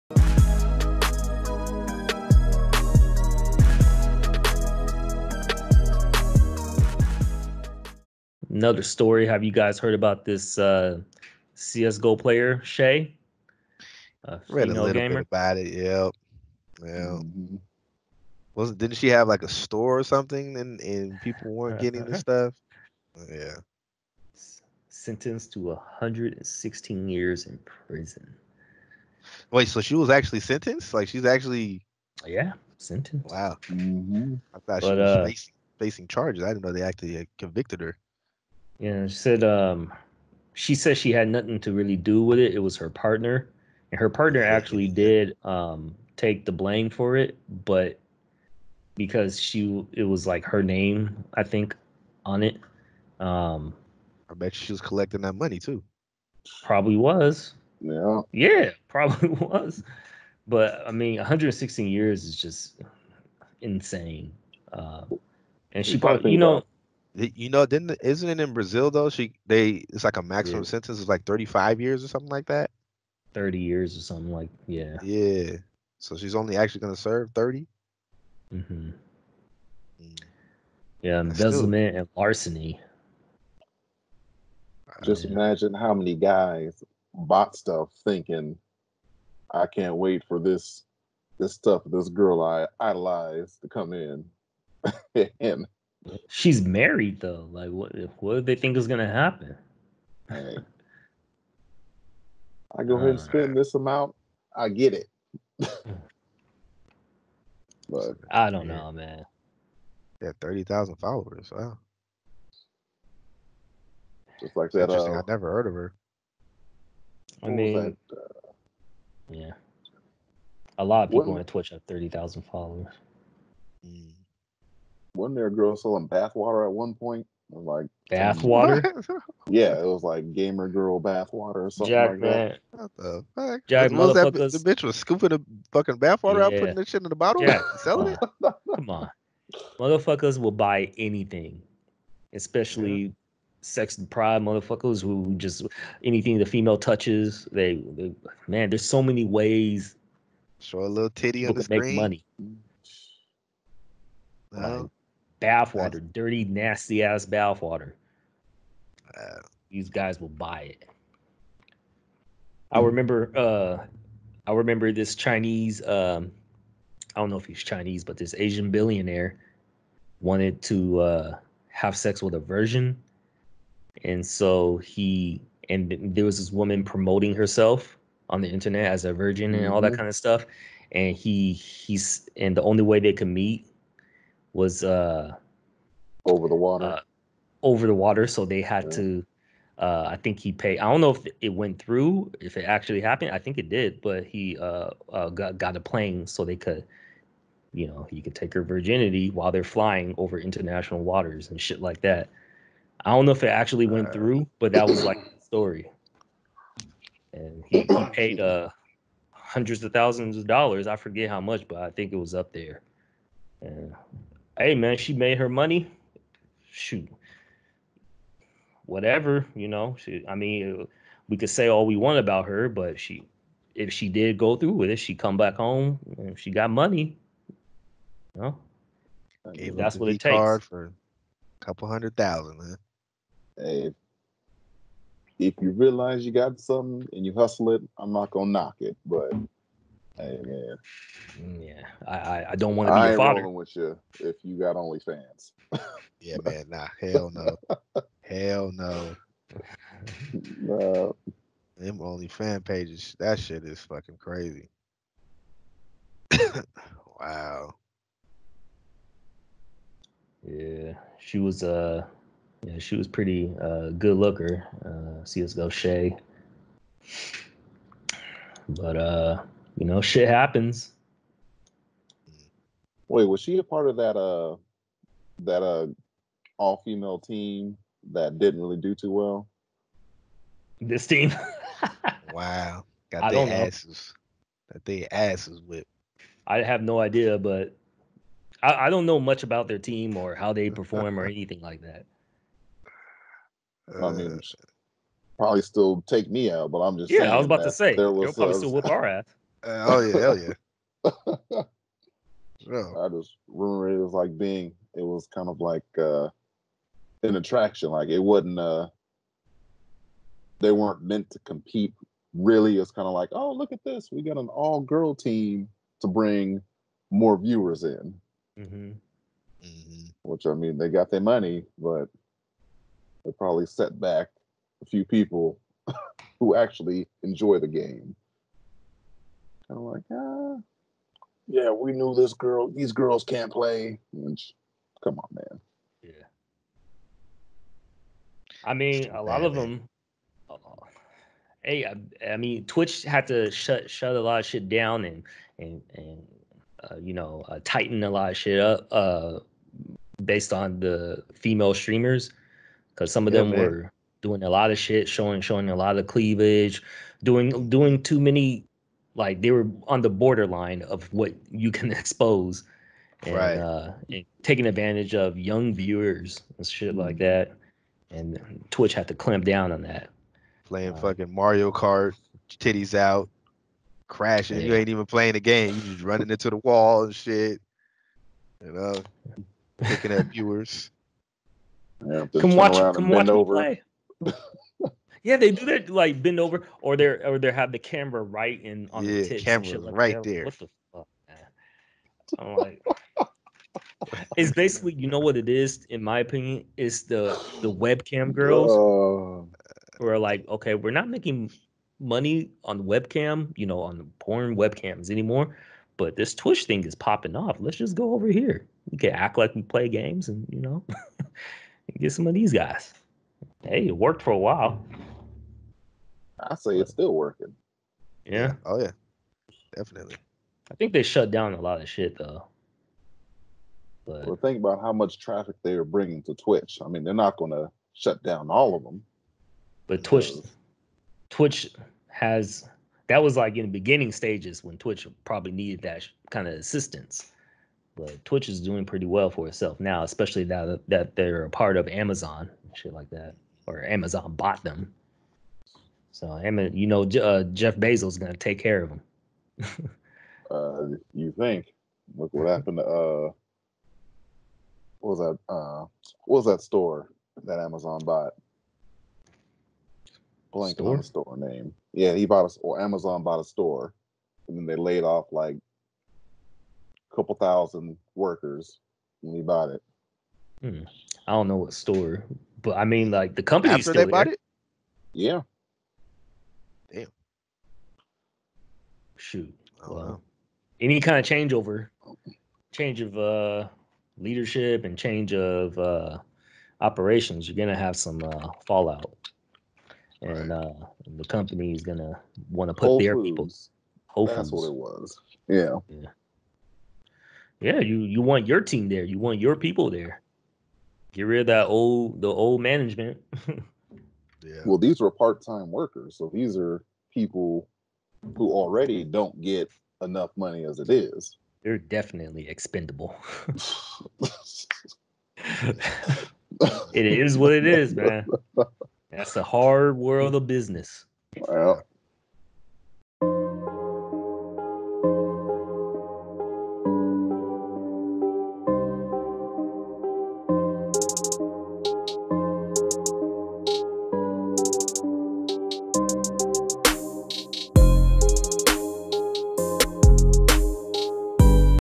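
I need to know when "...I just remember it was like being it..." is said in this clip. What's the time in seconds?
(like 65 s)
302 s.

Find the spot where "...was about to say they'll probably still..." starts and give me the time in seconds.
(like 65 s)
297 s.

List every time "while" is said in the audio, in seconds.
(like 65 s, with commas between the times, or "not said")
199 s, 414 s.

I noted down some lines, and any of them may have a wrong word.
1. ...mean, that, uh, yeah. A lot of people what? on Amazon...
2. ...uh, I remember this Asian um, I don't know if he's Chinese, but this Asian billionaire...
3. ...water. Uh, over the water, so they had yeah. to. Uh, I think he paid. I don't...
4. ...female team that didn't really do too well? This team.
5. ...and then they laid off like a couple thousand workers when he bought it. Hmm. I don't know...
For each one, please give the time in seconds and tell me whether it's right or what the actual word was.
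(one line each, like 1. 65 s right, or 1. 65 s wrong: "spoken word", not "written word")
1. 117 s wrong: "Twitch", not "Amazon"
2. 163 s wrong: "Chinese", not "Asian"
3. 186 s right
4. 276 s right
5. 464 s right.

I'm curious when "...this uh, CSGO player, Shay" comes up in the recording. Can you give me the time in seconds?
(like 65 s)
10 s.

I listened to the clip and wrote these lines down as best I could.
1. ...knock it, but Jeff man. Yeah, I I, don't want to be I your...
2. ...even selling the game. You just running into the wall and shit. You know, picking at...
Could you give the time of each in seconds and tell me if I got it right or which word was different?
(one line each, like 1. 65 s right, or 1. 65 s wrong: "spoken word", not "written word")
1. 238 s wrong: "Hey", not "Jeff"
2. 374 s wrong: "playing", not "selling".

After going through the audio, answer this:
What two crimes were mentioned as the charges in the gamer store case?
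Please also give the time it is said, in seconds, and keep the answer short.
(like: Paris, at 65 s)
Embezzlement and larceny, at 81 s.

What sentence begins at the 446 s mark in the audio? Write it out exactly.
So him and you know uh, Jeff Bezos gonna take care of him.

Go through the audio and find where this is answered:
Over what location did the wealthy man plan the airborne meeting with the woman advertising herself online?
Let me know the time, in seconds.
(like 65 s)
200 s.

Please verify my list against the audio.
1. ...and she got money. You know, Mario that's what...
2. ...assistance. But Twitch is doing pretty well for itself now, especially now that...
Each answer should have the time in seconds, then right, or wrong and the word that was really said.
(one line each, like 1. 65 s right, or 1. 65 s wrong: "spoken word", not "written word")
1. 226 s wrong: "Gave", not "Mario"
2. 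436 s right.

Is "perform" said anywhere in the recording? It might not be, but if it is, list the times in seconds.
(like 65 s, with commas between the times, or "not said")
290 s.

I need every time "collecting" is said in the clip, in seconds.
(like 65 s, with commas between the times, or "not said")
54 s.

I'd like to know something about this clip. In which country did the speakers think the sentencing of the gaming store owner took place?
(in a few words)
Brazil.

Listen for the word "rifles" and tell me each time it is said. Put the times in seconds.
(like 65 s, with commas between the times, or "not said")
not said.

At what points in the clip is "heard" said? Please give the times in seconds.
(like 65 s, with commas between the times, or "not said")
9 s, 115 s.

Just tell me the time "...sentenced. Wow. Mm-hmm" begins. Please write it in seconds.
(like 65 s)
32 s.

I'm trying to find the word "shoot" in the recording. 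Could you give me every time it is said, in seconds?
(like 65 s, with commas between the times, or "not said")
216 s, 479 s.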